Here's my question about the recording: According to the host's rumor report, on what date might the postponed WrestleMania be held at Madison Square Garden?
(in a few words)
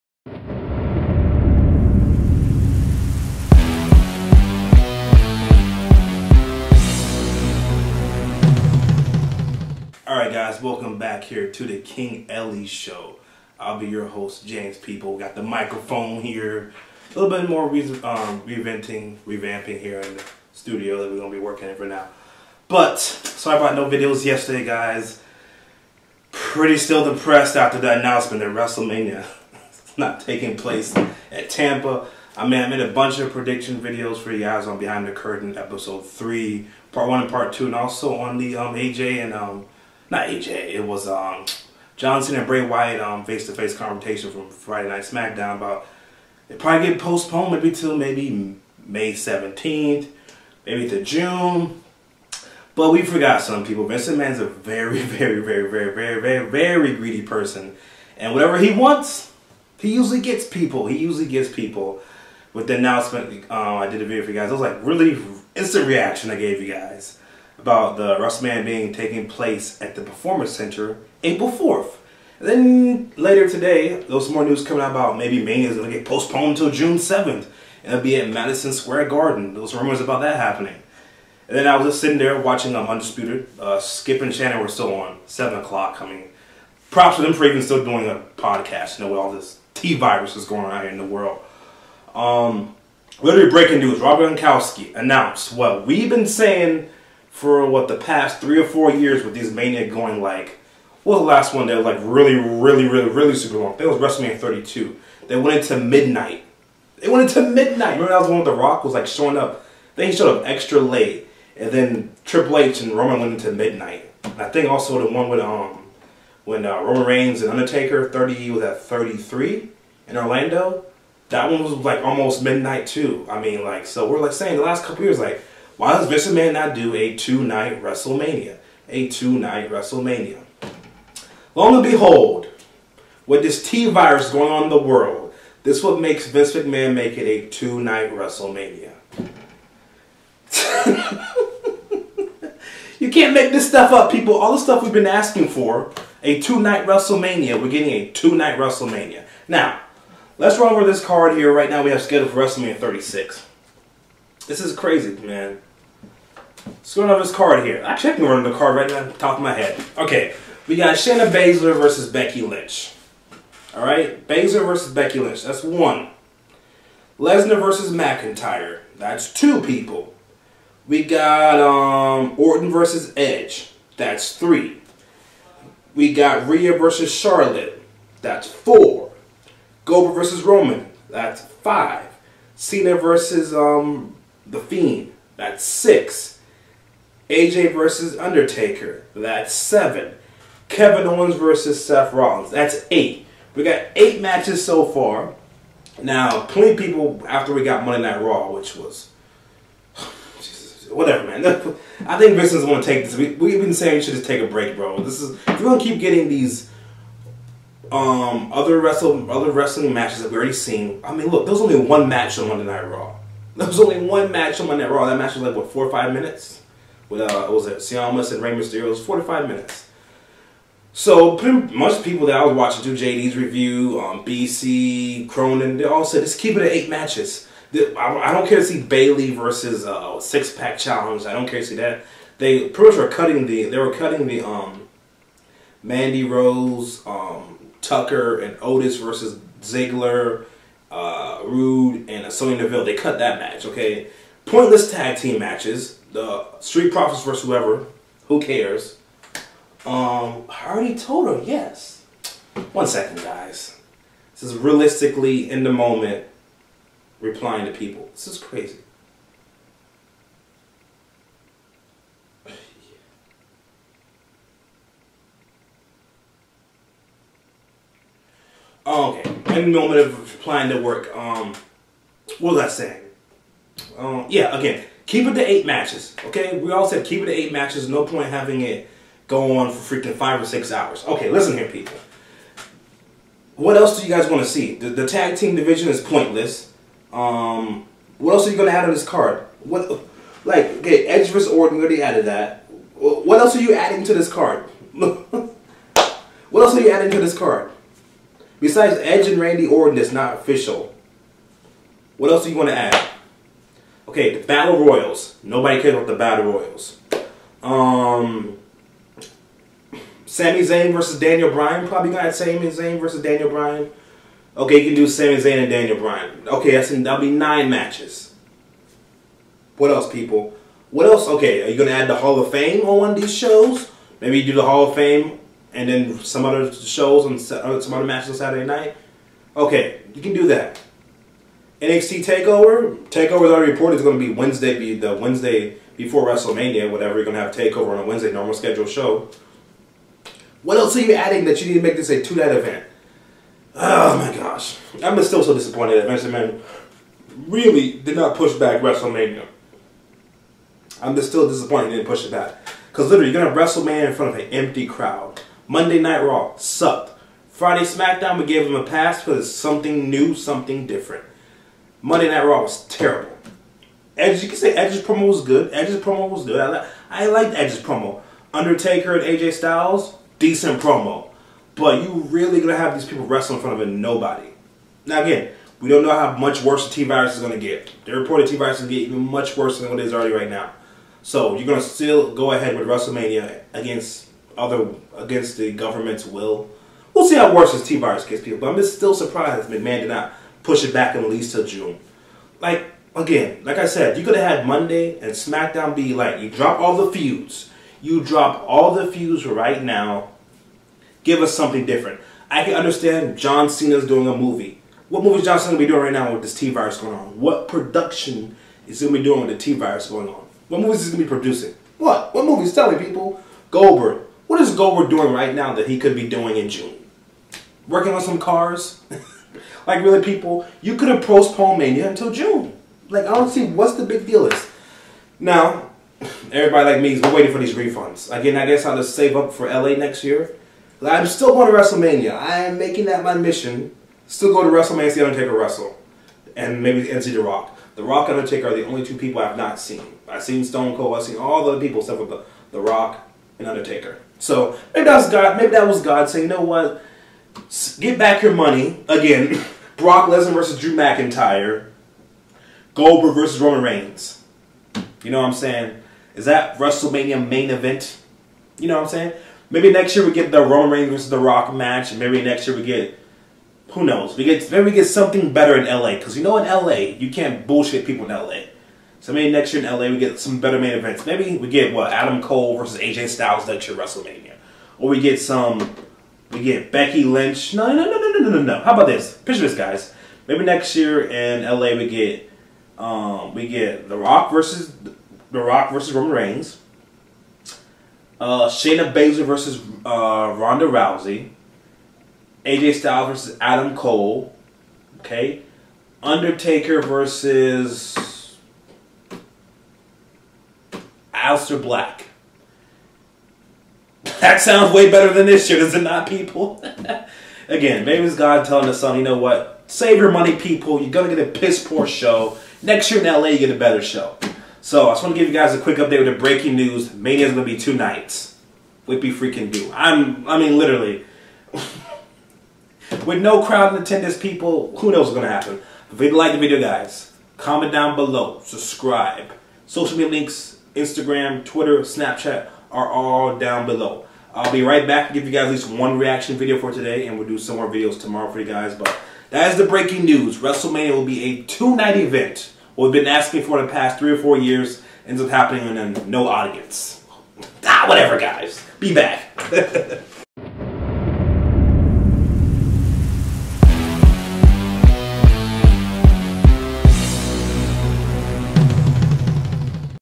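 June 7th.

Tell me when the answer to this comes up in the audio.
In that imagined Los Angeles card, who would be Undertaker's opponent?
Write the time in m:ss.
8:21.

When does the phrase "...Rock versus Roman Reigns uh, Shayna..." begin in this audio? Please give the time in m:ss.
8:05.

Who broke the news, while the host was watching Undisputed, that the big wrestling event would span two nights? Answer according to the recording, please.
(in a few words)
Robert Gronkowski.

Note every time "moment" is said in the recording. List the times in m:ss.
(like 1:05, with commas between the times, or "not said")
4:15, 4:29.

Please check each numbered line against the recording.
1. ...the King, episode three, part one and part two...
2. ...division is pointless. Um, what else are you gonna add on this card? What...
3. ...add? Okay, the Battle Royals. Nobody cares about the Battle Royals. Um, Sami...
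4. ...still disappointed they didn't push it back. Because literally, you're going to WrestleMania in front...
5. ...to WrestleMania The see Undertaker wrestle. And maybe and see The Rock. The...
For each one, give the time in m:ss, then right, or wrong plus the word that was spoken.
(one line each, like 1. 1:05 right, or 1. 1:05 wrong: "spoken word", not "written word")
1. 0:35 wrong: "Curtain", not "King"
2. 4:45 right
3. 5:02 right
4. 5:51 right
5. 7:14 right.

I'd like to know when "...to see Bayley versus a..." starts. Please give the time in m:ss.
3:48.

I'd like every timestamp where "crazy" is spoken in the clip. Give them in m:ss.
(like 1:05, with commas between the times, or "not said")
2:34, 4:18.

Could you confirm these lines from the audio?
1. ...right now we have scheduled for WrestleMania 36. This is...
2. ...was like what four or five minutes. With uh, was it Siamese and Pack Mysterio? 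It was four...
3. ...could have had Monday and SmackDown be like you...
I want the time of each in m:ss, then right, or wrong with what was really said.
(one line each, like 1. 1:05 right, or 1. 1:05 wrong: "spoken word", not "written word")
1. 2:31 right
2. 3:35 wrong: "Rey", not "Pack"
3. 6:34 right.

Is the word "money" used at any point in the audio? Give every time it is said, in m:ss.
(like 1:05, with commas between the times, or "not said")
7:28, 8:30.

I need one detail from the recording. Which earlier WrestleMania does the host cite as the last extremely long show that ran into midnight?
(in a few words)
WrestleMania 32.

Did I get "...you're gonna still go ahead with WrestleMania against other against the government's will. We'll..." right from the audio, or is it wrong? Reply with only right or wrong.
right.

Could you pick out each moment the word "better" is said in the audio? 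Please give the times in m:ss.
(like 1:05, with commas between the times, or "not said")
7:45, 7:50, 8:25, 8:33.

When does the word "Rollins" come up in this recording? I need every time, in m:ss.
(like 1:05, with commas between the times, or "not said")
3:12.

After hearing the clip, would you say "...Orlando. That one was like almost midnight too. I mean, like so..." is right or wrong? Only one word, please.
right.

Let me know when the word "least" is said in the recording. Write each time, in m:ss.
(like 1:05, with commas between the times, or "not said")
6:31, 8:55.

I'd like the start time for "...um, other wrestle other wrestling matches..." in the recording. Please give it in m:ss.
3:27.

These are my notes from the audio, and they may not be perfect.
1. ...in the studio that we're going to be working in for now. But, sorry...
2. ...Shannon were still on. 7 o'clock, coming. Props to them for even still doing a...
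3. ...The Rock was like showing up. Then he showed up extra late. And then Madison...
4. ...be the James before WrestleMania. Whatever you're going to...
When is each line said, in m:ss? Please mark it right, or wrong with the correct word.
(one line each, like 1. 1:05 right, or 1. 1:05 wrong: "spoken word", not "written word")
1. 0:20 right
2. 1:24 right
3. 1:48 wrong: "Triple", not "Madison"
4. 5:34 wrong: "Wednesday", not "James".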